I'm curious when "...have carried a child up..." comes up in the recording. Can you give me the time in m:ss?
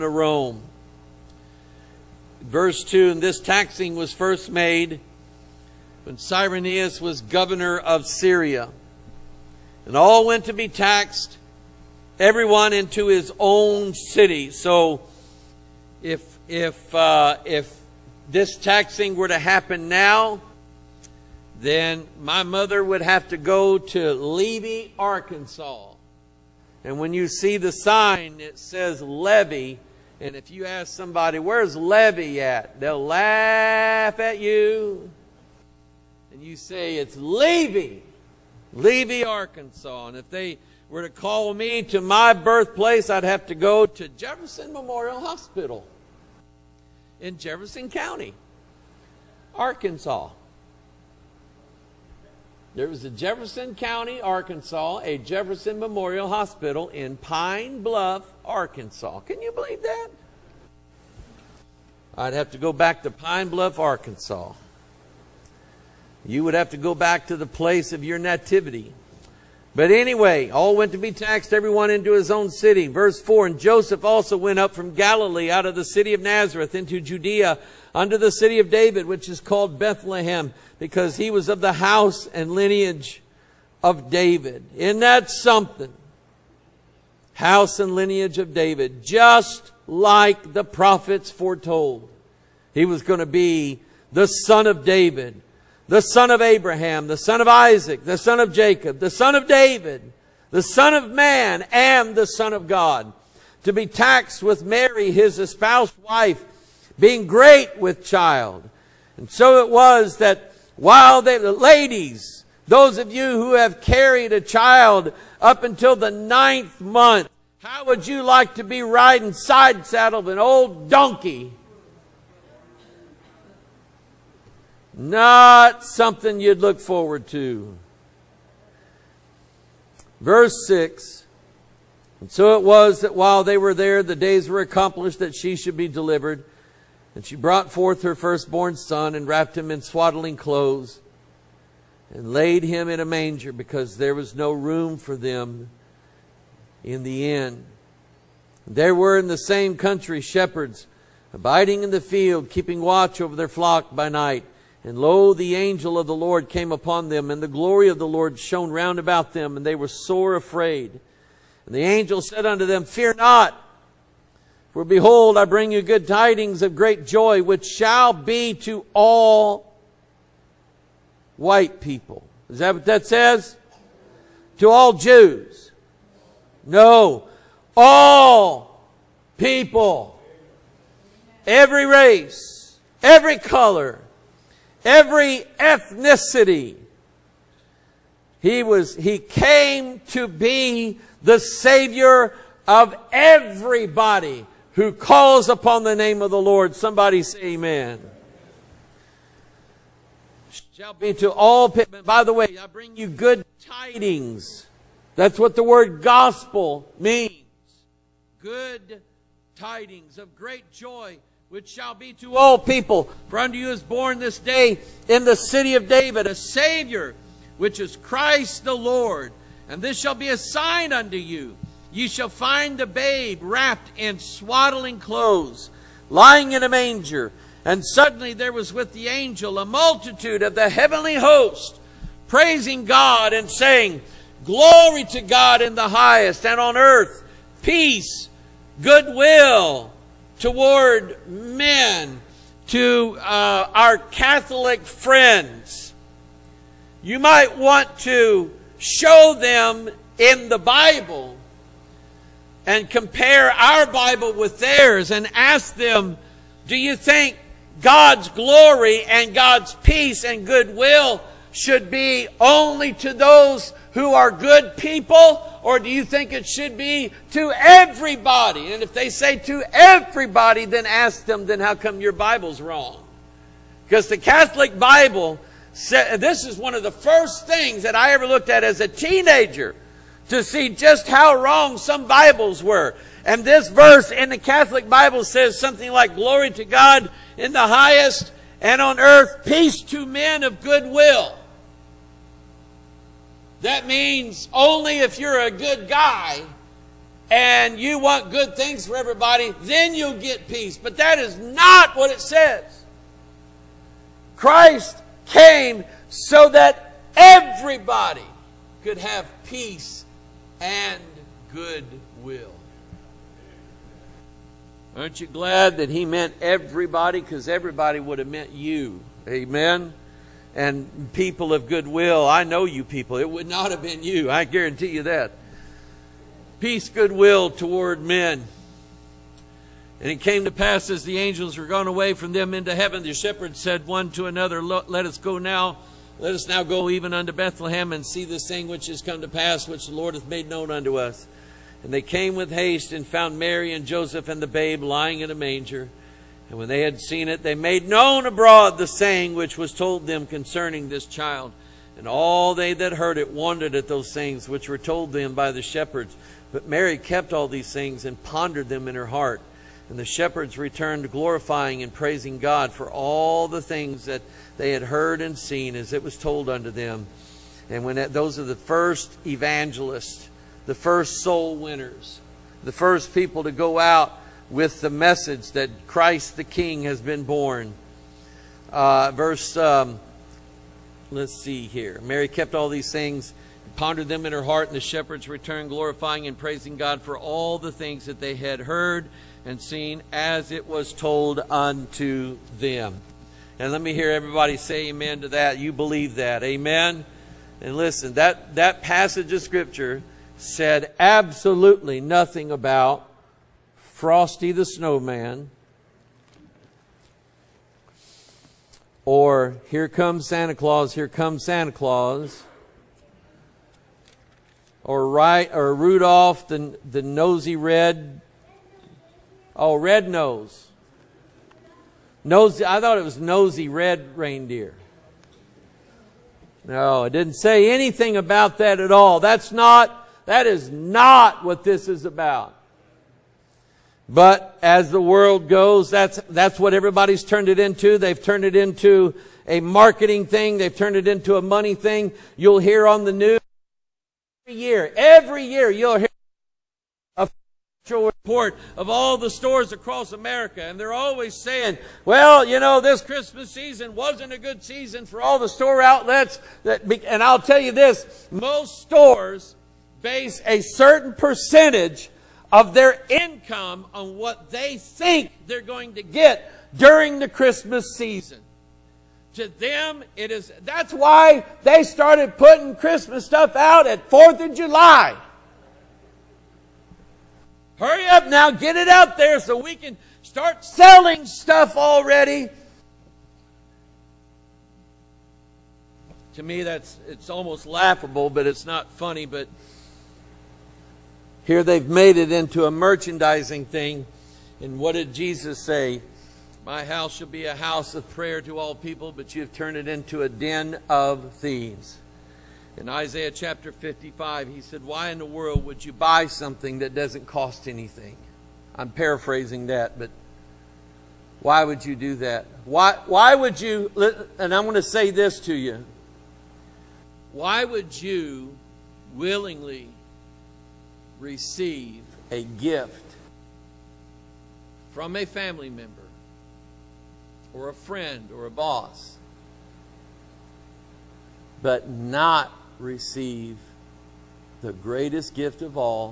1:53.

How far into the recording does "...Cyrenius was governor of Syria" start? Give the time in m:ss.
0:06.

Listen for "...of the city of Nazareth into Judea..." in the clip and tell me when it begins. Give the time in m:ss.
1:15.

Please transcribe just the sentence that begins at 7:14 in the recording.
But as the world goes, that's, that's what everybody's turned it into.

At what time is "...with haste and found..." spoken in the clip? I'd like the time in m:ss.
5:42.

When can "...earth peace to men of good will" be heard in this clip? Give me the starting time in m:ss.
4:48.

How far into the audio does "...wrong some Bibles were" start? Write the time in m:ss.
4:41.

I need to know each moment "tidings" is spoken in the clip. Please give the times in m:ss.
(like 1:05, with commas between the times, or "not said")
2:46, 3:23, 3:29.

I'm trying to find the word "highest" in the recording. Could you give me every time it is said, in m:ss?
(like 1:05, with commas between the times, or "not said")
3:55, 4:47.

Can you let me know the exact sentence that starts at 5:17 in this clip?
Because everybody would have meant you.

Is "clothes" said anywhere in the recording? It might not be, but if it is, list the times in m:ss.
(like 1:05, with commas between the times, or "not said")
2:20, 3:44.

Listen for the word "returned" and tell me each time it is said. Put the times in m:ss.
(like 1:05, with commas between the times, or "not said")
6:00, 6:25.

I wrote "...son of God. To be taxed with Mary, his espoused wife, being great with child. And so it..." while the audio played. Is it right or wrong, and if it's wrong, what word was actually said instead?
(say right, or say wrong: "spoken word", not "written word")
right.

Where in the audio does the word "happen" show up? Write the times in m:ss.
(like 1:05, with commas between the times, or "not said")
0:19.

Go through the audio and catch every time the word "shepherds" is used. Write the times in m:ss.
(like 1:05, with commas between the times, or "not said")
2:30, 5:33, 5:55, 6:00, 6:24.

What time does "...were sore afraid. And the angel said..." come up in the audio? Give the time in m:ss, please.
2:39.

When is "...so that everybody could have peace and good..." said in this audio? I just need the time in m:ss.
5:06.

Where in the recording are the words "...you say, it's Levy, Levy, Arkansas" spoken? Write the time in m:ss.
0:36.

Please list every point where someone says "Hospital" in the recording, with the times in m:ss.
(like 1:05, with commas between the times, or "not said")
0:45, 0:56.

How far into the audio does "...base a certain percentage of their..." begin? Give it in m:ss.
7:40.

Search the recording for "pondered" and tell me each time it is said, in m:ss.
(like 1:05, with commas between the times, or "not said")
5:58, 6:23.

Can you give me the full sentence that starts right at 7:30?
And they're always saying, well, you know, this Christmas season wasn't a good season for all the store outlets.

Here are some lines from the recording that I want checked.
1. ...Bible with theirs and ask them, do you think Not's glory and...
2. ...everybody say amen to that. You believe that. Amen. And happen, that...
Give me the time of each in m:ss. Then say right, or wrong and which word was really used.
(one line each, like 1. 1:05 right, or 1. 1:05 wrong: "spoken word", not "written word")
1. 4:13 wrong: "God", not "Not"
2. 6:34 wrong: "listen", not "happen".